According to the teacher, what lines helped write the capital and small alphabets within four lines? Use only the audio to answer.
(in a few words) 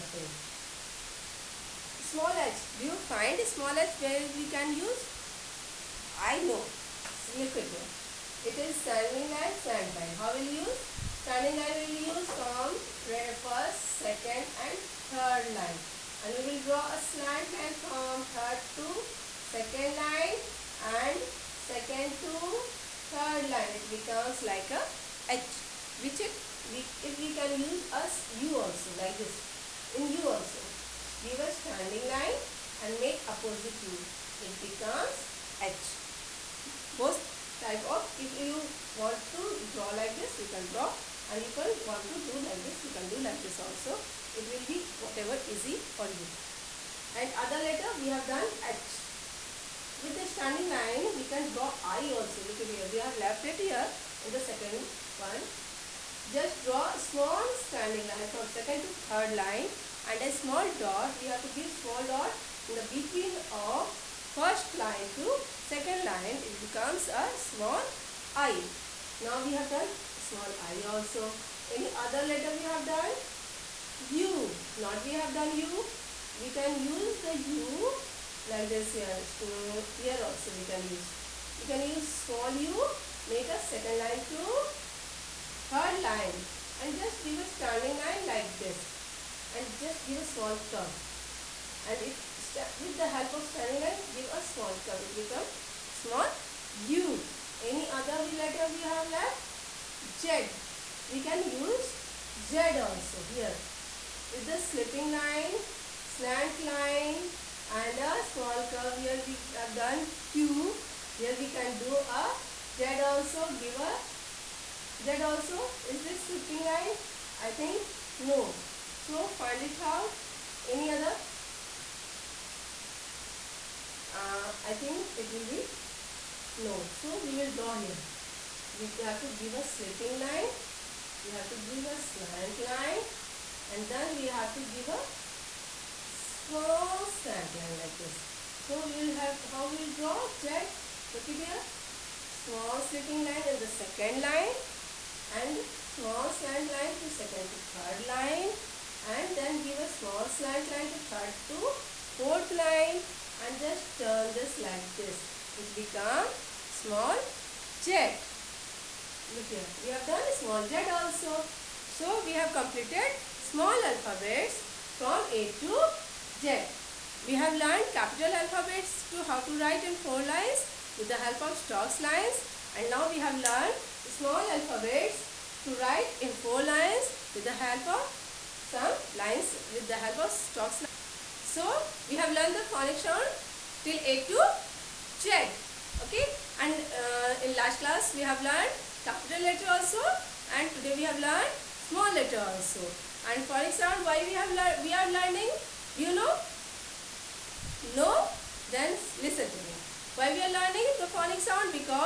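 stocks lines.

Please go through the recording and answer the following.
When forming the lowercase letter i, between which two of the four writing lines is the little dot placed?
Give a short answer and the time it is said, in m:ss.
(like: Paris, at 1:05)
first line to second line, at 1:04.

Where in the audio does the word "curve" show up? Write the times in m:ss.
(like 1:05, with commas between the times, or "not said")
1:30, 1:34, 1:48.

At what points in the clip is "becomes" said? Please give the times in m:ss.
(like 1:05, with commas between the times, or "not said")
0:23, 0:34, 1:06, 1:35, 2:35.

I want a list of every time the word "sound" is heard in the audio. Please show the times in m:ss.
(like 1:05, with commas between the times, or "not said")
3:02, 3:13, 3:21.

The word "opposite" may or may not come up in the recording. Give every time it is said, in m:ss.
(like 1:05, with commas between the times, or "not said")
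0:33.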